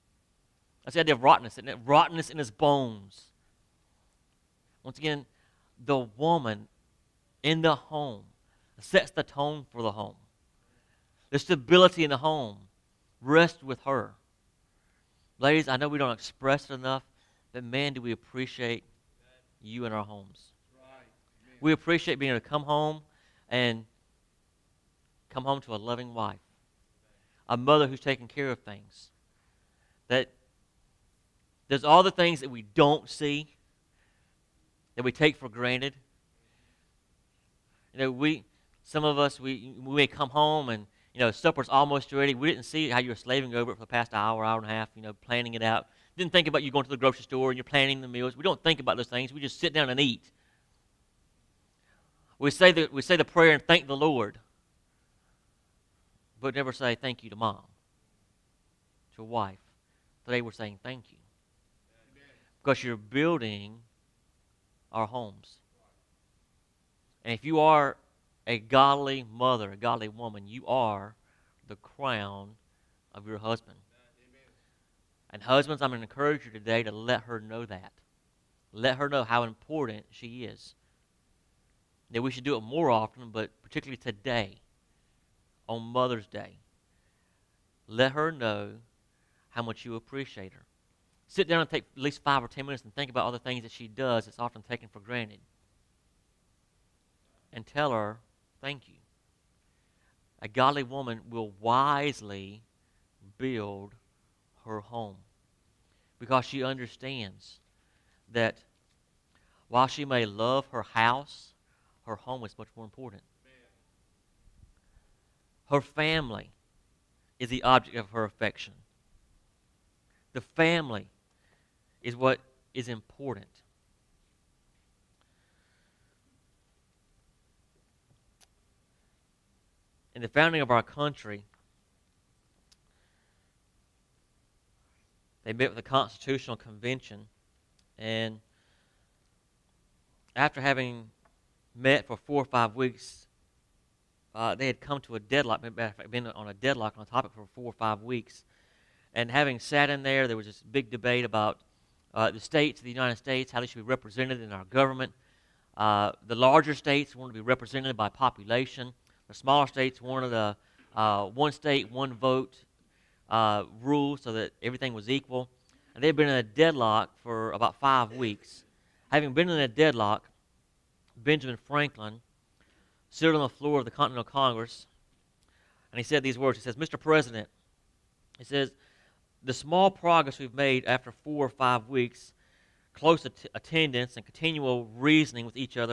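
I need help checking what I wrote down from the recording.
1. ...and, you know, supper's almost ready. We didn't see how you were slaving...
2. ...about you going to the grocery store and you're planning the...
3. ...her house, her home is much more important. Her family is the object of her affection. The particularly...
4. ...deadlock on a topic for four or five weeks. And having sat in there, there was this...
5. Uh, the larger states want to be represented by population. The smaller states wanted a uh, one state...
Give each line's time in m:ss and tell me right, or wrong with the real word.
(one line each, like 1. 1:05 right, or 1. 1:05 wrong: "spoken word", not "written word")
1. 0:40 right
2. 0:46 right
3. 1:50 wrong: "family", not "particularly"
4. 2:26 right
5. 2:35 right.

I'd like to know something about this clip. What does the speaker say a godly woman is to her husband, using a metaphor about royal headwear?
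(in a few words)
The crown.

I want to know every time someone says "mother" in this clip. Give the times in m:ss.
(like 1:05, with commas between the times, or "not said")
0:27, 1:09, 1:25.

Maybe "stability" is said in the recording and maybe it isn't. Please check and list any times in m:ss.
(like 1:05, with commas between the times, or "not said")
0:11.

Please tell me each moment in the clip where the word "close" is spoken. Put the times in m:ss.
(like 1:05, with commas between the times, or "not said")
3:02.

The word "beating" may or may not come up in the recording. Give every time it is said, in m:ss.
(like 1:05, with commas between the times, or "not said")
not said.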